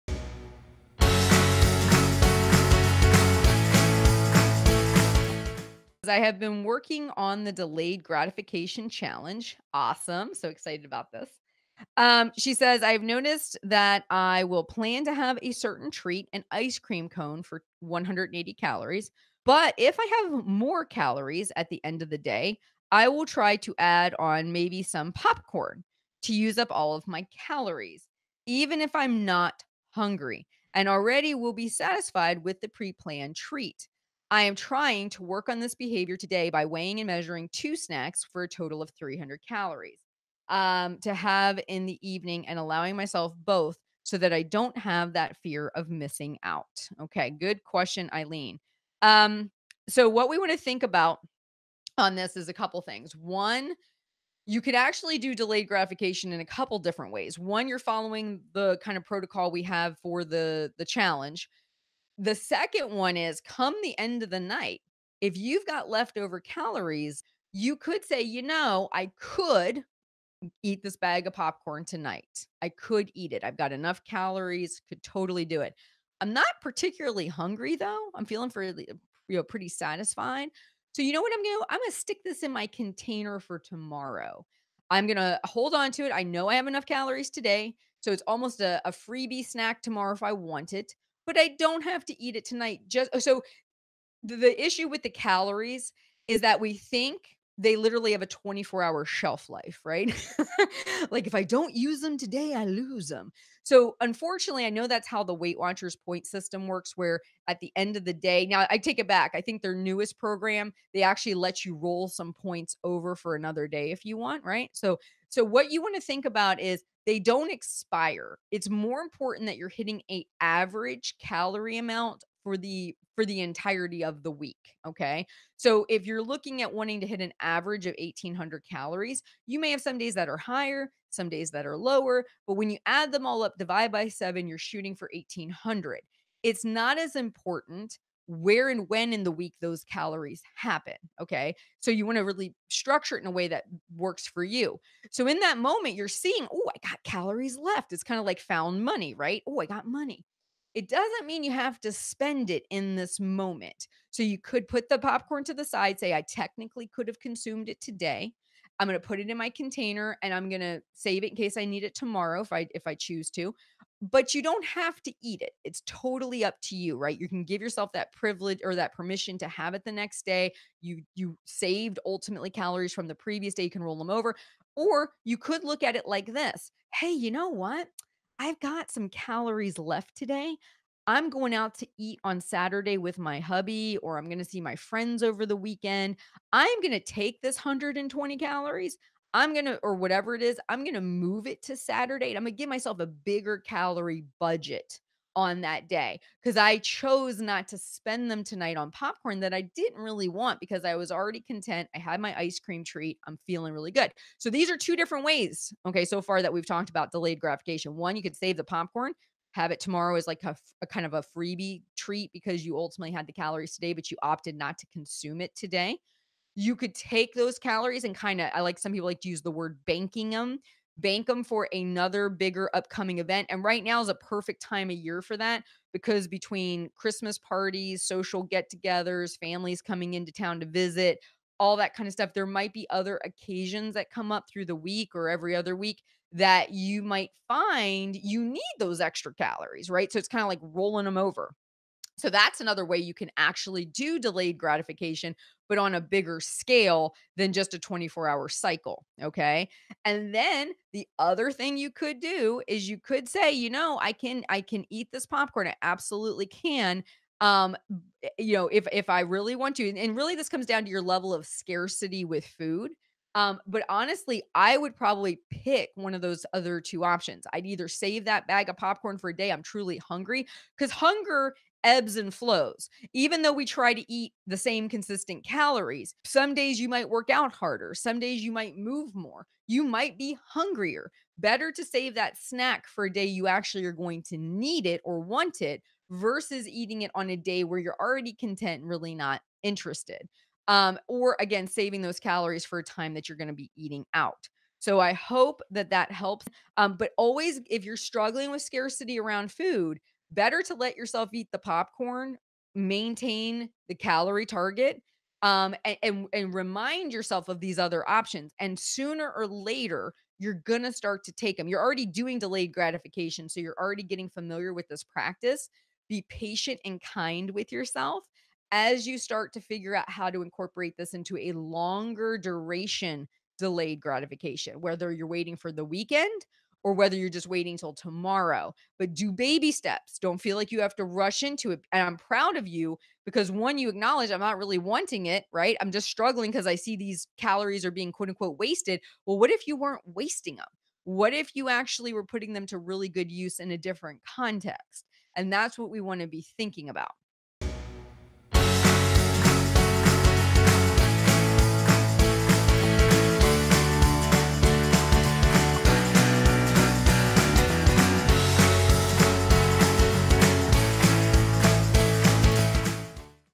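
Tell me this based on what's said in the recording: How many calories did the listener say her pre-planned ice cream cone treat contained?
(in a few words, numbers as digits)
180.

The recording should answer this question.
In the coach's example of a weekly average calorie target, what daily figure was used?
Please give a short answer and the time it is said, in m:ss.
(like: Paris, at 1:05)
1800, at 2:07.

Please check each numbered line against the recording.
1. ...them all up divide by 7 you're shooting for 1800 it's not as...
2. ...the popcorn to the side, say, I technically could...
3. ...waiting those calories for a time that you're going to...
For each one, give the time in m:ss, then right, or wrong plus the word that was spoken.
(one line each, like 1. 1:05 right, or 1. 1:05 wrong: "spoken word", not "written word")
1. 2:13 right
2. 2:34 right
3. 4:51 wrong: "saving", not "waiting".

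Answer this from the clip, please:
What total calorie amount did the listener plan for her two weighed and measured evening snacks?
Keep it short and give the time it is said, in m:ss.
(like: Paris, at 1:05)
300, at 0:38.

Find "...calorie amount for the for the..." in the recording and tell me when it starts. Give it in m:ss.
2:01.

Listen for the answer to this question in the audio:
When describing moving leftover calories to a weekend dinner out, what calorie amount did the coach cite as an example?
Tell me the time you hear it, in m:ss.
3:07.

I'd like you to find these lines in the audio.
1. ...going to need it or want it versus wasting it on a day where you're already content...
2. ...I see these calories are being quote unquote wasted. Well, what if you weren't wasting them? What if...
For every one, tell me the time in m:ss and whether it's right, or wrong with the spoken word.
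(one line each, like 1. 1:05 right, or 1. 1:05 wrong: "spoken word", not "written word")
1. 4:43 wrong: "eating", not "wasting"
2. 5:36 right.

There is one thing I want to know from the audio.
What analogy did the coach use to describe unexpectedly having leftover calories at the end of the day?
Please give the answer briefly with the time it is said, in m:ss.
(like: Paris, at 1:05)
found money, at 2:28.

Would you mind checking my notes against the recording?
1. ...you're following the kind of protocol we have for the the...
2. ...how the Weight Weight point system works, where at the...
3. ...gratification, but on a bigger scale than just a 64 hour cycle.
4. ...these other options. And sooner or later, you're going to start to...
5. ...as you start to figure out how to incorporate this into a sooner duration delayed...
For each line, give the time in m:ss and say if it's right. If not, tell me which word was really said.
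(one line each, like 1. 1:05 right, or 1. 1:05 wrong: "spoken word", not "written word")
1. 0:57 right
2. 1:45 wrong: "Watchers", not "Weight"
3. 4:04 wrong: "24", not "64"
4. 5:07 right
5. 5:18 wrong: "longer", not "sooner".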